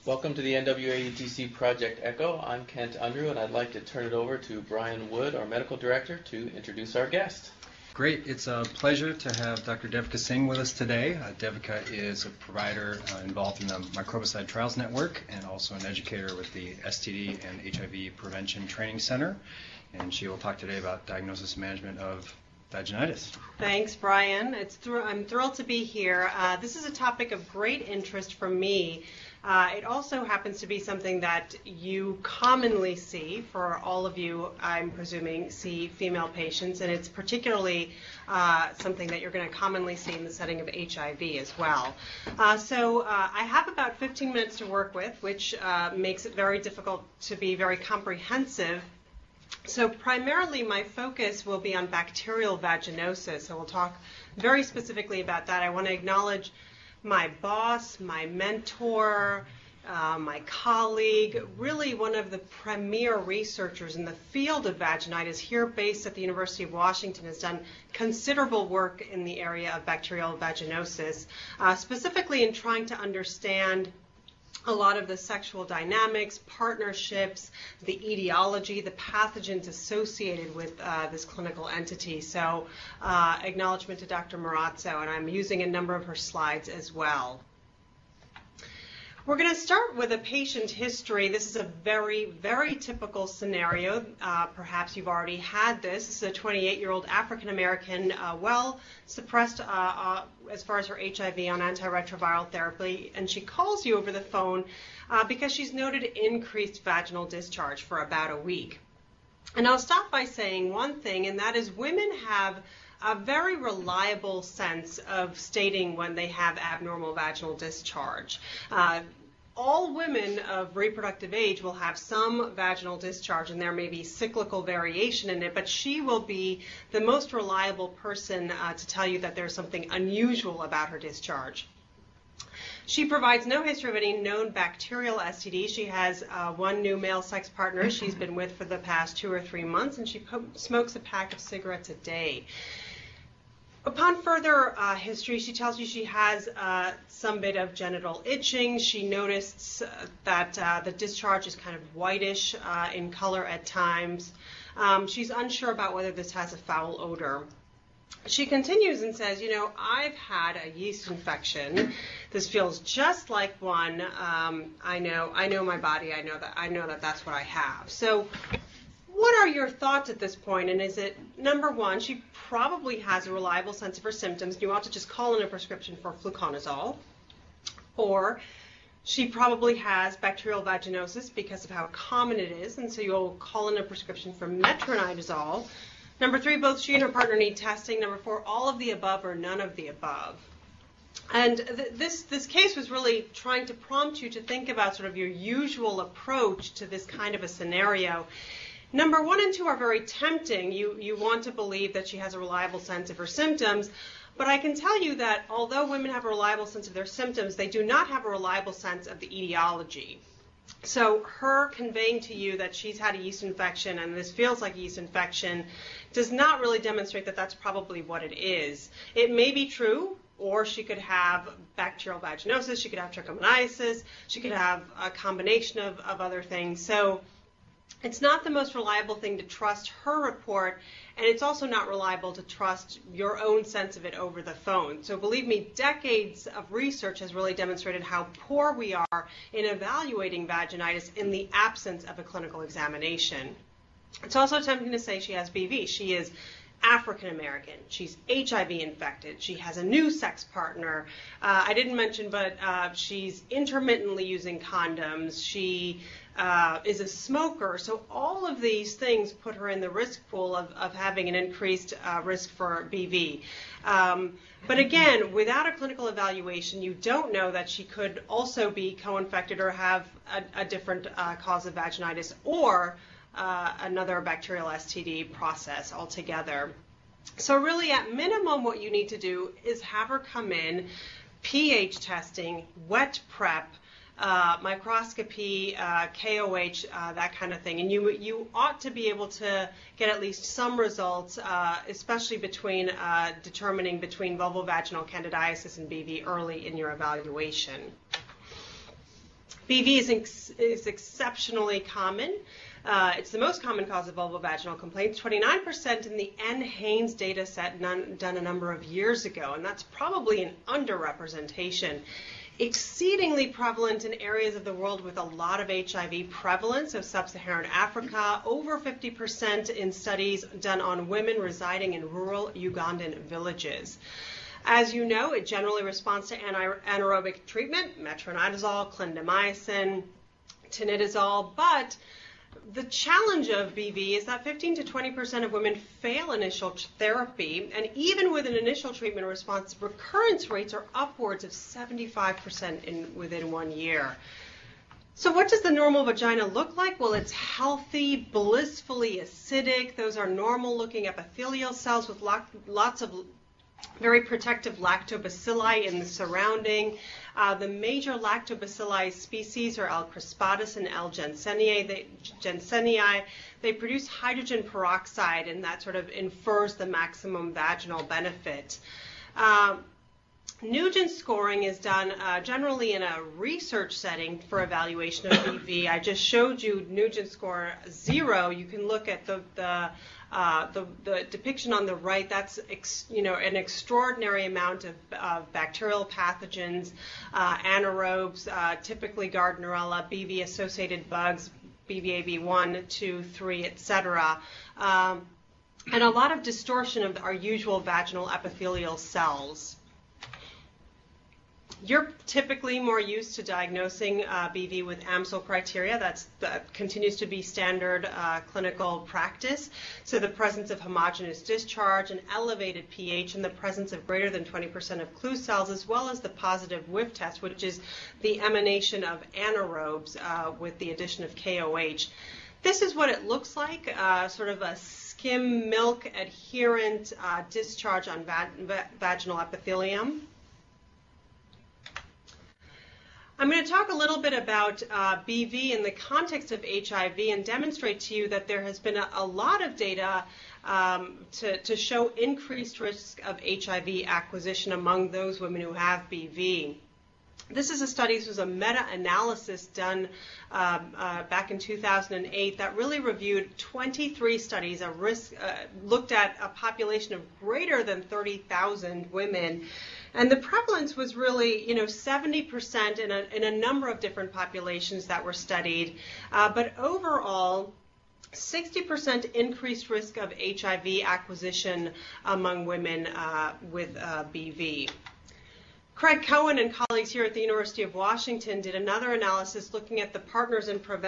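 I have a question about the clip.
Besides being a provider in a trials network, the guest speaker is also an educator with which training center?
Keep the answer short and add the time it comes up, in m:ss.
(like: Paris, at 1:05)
STD and HIV Prevention Training Center, at 0:16.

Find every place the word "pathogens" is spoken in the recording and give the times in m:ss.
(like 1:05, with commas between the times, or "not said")
1:18, 6:26.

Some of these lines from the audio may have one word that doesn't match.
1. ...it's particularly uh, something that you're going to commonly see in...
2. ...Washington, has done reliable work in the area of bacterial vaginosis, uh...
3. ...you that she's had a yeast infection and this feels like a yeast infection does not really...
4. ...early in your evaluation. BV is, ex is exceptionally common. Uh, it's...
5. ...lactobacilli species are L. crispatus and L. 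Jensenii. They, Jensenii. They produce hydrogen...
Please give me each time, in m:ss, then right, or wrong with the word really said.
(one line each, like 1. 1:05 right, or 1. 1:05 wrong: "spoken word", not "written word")
1. 0:36 right
2. 1:06 wrong: "considerable", not "reliable"
3. 3:32 right
4. 4:56 right
5. 5:58 right.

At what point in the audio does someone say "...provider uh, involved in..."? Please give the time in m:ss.
0:12.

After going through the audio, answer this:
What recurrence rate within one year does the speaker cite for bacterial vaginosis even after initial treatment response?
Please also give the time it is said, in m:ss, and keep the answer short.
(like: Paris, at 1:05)
75%, at 5:41.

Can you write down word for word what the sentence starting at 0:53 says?
So we'll talk very specifically about that.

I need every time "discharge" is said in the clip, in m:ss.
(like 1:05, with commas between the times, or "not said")
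1:47, 1:57, 2:02, 2:10, 2:30, 6:51, 7:07.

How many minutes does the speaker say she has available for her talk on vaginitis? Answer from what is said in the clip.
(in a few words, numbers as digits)
15.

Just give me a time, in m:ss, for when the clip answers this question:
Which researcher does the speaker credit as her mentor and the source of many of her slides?
1:24.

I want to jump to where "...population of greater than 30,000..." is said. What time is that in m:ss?
7:36.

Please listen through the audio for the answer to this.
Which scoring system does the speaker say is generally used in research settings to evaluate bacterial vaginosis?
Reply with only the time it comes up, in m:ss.
6:10.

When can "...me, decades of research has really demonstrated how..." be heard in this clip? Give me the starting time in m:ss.
3:55.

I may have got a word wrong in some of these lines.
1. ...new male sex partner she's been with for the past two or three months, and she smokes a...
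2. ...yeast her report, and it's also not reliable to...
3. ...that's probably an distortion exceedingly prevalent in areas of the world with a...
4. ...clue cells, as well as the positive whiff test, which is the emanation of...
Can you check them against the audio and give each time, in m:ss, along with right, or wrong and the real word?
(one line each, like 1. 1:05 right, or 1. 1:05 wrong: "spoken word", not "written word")
1. 2:16 right
2. 3:49 wrong: "trust", not "yeast"
3. 5:09 wrong: "underrepresentation", not "distortion"
4. 6:55 right.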